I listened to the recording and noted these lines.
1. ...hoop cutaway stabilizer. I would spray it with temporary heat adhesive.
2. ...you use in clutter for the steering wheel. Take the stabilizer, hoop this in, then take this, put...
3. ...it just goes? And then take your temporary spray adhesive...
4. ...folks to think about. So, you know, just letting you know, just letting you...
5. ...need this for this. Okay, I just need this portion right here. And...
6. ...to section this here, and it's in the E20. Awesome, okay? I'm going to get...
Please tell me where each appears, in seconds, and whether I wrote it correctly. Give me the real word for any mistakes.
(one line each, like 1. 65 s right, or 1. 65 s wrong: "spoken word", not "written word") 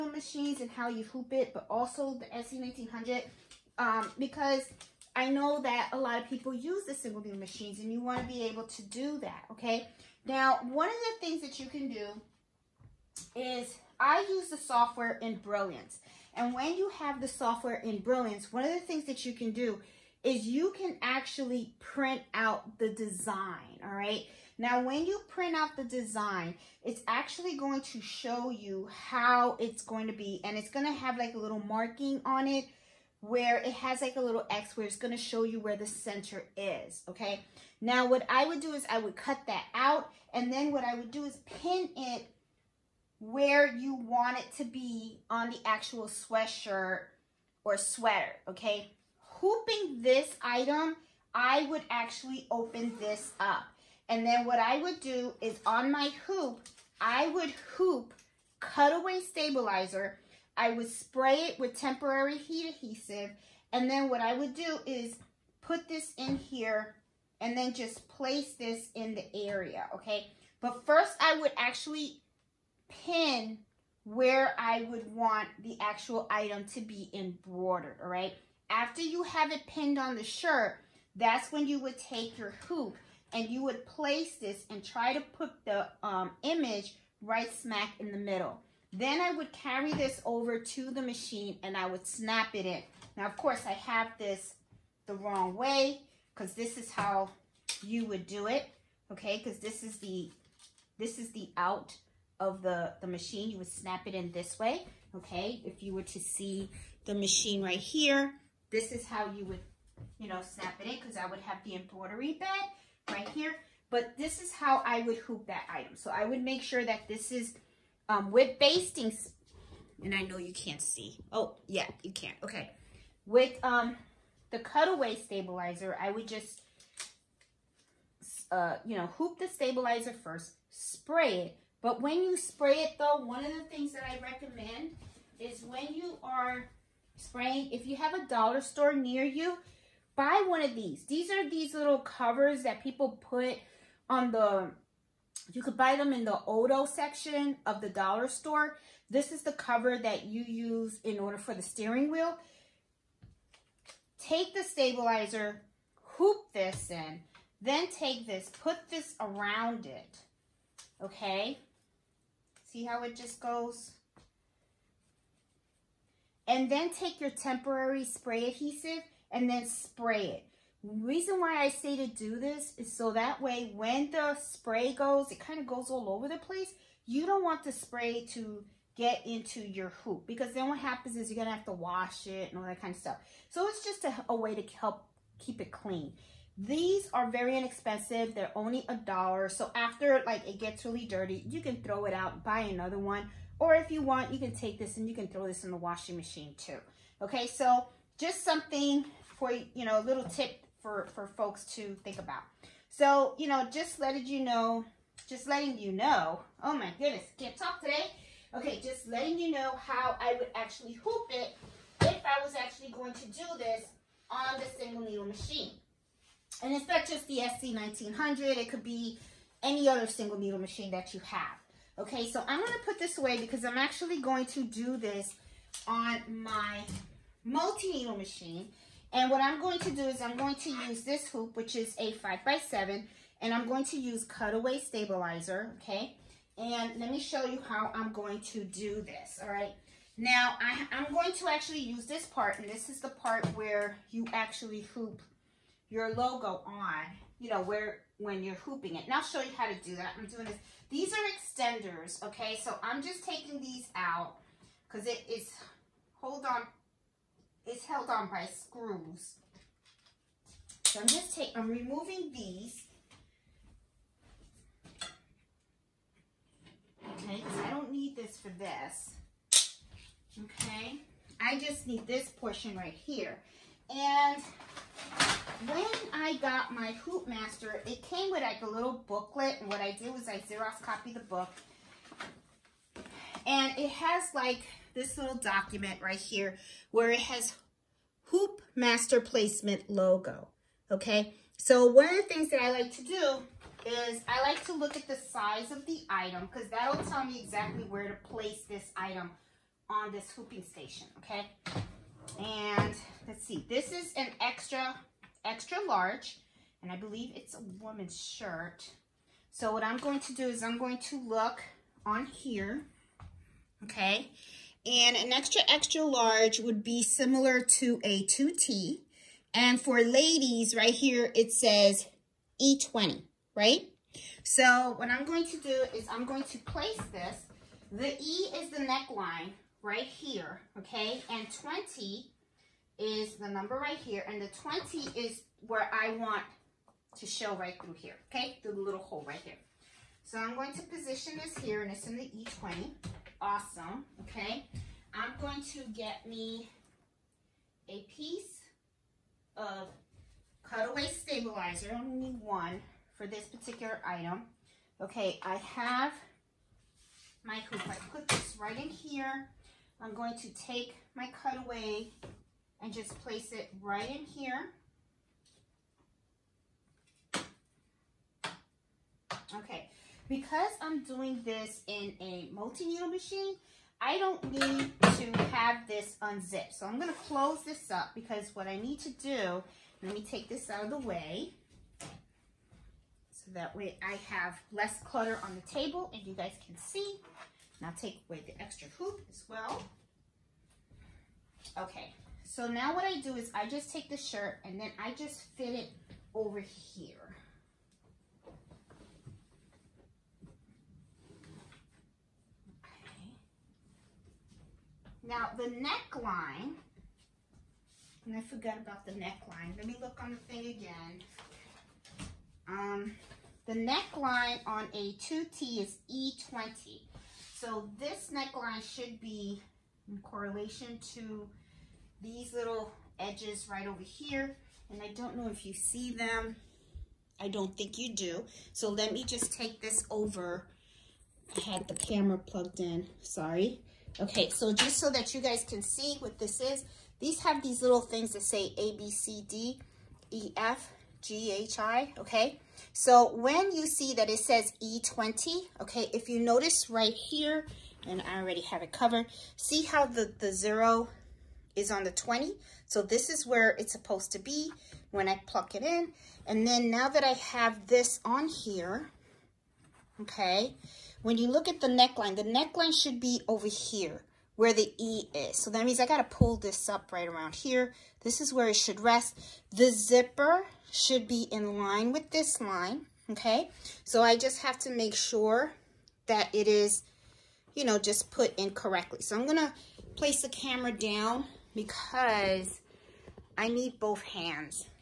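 1. 57 s right
2. 150 s wrong: "order", not "clutter"
3. 163 s right
4. 201 s right
5. 267 s right
6. 340 s wrong: "position", not "section".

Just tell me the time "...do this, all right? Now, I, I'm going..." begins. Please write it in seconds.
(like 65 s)
238 s.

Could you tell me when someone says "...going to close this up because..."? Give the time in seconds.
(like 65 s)
376 s.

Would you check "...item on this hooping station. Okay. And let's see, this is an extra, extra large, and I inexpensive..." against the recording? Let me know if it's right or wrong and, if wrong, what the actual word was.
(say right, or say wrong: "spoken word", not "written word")
wrong: "believe", not "inexpensive".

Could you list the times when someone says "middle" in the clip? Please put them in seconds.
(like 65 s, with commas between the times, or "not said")
88 s.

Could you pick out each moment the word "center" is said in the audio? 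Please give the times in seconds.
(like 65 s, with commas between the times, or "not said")
35 s.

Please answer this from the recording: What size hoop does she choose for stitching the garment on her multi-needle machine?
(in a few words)
5 by 7.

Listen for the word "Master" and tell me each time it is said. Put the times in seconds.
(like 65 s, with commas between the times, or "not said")
277 s, 288 s.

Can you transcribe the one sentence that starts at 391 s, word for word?
Okay, so now what I do is I just take the shirt and then I just fit it over here.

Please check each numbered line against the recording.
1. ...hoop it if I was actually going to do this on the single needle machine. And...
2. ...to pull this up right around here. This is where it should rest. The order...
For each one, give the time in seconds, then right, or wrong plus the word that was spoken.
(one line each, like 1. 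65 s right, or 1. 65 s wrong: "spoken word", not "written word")
1. 210 s right
2. 466 s wrong: "zipper", not "order".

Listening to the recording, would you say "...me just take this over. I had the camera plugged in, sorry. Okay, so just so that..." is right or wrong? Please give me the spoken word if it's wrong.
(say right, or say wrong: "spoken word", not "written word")
right.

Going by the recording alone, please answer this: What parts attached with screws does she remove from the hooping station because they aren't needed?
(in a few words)
Extenders.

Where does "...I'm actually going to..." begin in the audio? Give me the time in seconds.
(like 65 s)
223 s.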